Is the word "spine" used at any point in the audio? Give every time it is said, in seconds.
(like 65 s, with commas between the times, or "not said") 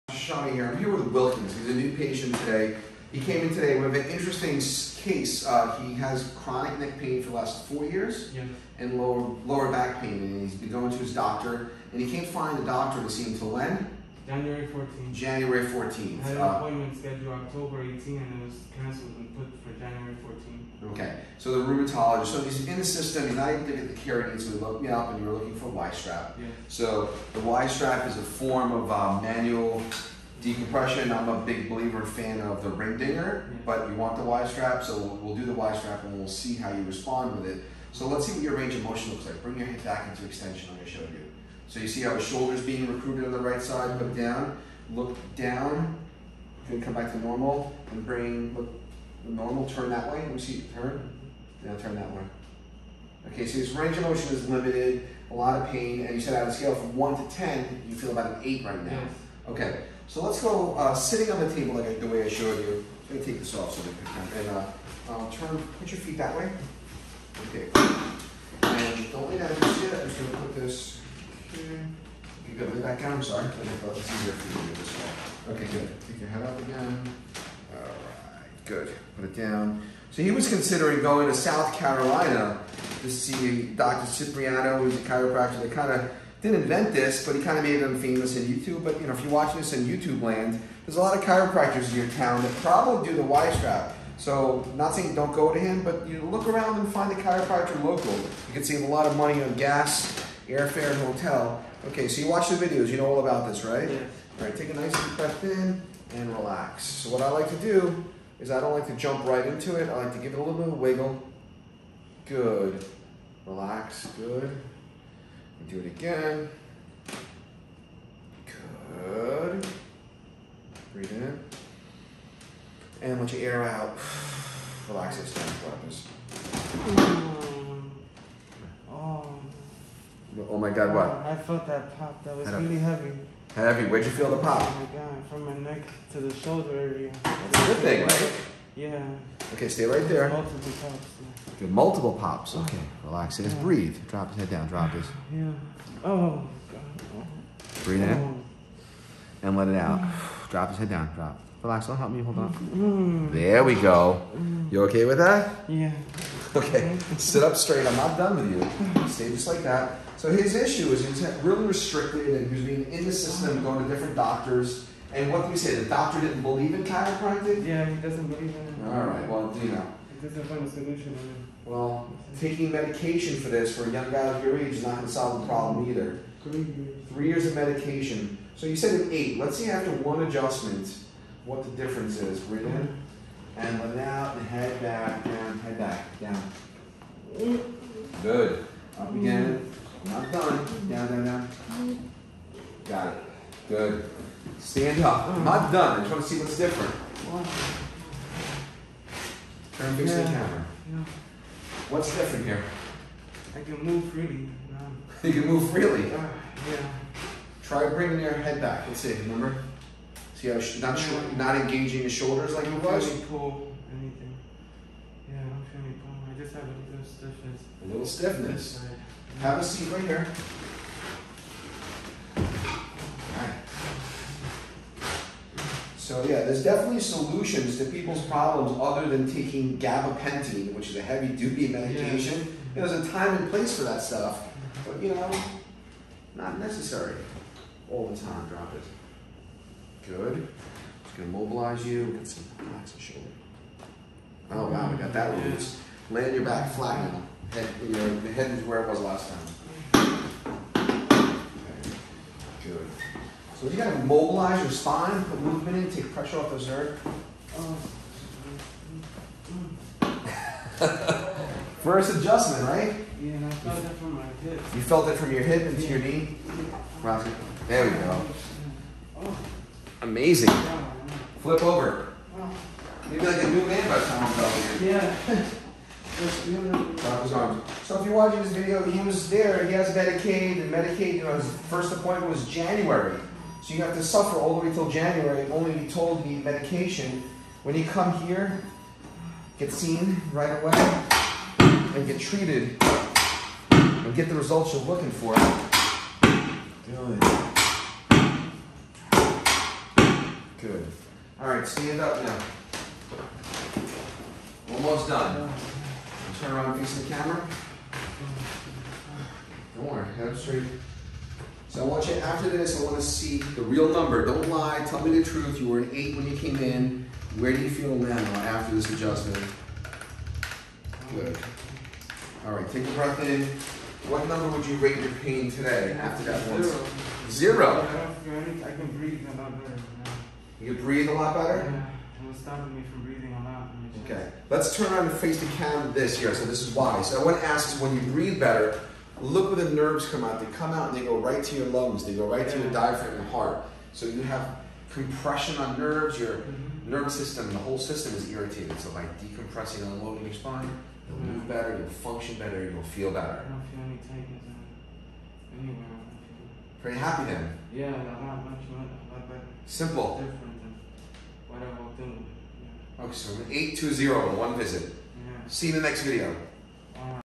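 254 s, 350 s.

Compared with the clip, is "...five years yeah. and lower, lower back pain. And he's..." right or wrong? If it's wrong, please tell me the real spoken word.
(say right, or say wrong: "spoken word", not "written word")
wrong: "four", not "five".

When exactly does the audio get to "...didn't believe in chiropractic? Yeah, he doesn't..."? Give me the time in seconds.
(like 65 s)
166 s.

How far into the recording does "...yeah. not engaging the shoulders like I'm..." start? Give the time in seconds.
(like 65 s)
210 s.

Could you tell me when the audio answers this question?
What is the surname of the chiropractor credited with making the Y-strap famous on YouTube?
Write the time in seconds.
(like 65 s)
84 s.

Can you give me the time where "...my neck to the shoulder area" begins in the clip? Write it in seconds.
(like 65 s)
135 s.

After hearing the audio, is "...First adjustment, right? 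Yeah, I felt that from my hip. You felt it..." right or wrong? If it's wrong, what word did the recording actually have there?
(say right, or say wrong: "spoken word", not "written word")
right.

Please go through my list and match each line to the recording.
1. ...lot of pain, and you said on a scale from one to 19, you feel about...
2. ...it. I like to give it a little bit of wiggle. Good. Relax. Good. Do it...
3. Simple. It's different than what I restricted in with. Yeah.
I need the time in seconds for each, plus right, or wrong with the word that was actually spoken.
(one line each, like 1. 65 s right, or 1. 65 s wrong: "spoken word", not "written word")
1. 55 s wrong: "10", not "19"
2. 109 s right
3. 359 s wrong: "walked", not "restricted".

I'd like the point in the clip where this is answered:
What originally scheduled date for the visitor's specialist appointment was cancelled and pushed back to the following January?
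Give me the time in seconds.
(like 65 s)
17 s.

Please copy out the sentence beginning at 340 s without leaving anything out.
They come out and they go right to your lungs.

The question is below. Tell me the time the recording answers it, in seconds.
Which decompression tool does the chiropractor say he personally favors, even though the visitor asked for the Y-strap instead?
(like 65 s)
32 s.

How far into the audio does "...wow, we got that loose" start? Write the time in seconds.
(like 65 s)
244 s.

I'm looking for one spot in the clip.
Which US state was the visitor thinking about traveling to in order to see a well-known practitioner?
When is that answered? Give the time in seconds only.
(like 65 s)
81 s.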